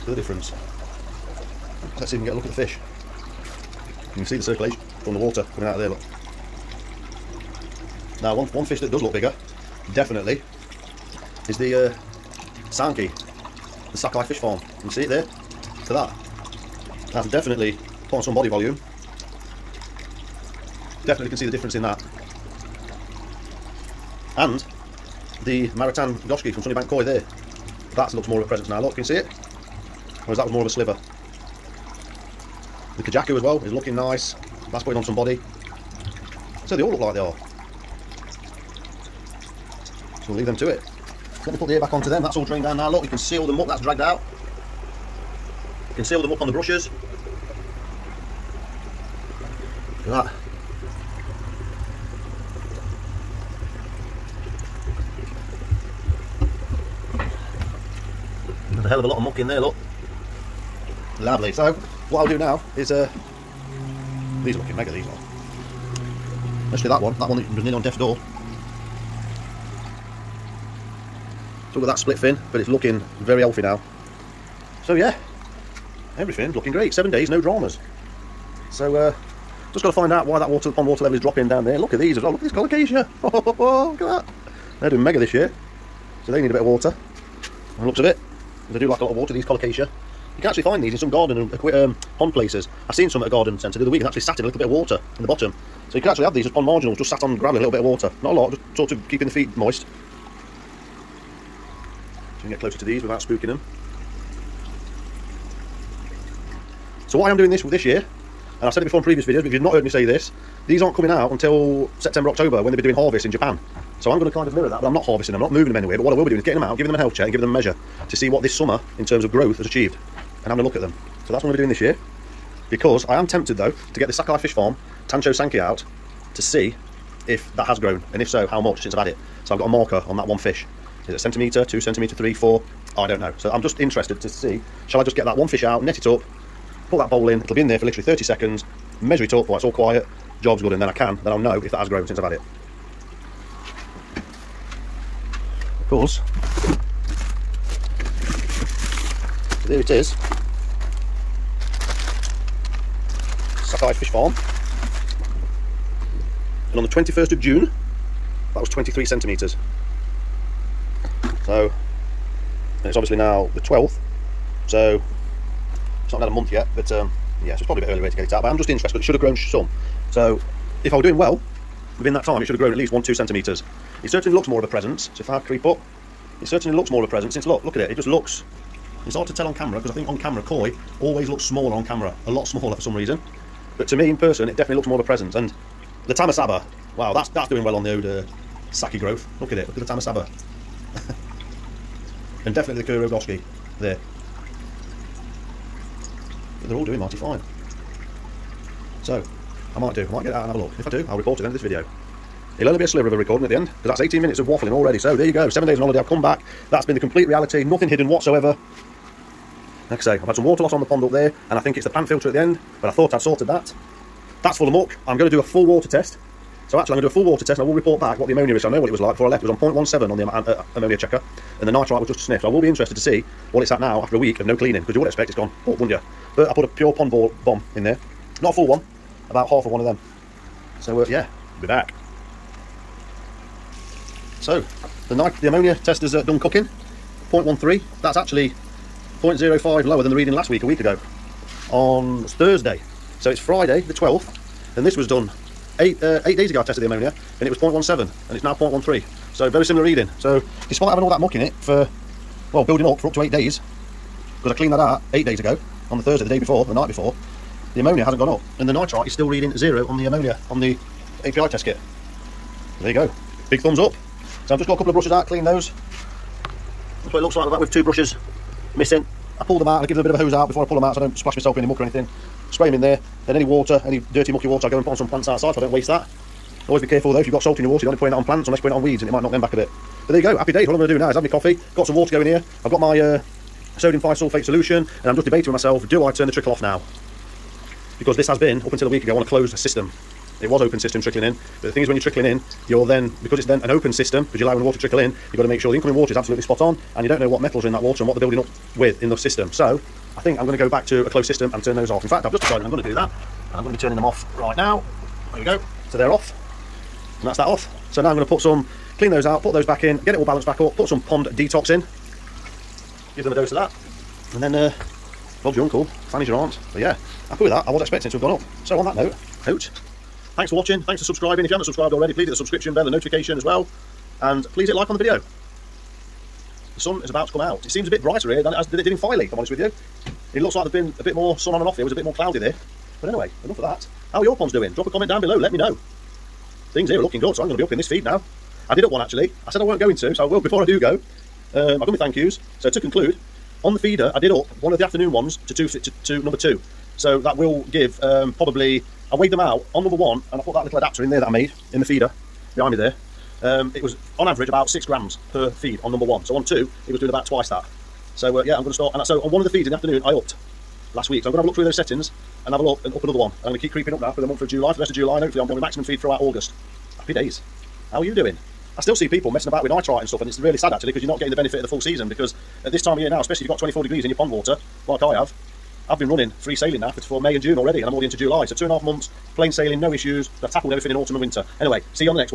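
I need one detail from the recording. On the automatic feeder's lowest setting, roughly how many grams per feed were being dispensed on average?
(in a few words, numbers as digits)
6 grams.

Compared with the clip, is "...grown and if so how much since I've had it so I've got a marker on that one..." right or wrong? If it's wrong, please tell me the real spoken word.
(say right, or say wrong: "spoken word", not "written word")
right.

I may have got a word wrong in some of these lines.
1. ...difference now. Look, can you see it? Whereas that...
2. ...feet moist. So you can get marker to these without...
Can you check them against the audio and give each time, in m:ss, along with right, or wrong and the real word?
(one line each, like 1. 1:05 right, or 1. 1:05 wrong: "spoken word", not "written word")
1. 0:28 wrong: "presence", not "difference"
2. 1:39 wrong: "closer", not "marker".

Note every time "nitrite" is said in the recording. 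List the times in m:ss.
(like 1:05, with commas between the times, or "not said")
3:41, 4:18, 6:09.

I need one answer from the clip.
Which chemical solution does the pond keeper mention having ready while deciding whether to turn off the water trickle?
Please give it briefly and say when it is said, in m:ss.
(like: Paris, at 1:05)
sodium thiosulfate, at 4:43.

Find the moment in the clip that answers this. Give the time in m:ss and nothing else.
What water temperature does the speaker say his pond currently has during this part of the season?
6:13.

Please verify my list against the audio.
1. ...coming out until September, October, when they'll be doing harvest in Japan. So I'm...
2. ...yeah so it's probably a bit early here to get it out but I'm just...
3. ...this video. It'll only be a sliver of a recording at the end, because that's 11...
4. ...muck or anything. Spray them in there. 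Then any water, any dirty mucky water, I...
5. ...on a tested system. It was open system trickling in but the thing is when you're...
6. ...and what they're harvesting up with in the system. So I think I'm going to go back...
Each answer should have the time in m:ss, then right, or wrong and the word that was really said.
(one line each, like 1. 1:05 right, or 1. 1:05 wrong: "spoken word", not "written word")
1. 1:50 right
2. 2:47 right
3. 3:21 wrong: "18", not "11"
4. 4:31 right
5. 4:49 wrong: "closed", not "tested"
6. 4:58 wrong: "building", not "harvesting".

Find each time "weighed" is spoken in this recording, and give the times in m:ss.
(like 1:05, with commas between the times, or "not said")
5:49.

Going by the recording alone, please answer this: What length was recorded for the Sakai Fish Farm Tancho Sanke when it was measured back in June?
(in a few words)
23 centimetres.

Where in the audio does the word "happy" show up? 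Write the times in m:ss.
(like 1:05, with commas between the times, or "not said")
4:40, 5:17, 6:07.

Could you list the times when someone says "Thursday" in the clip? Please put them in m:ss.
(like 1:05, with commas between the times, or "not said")
4:02, 4:16.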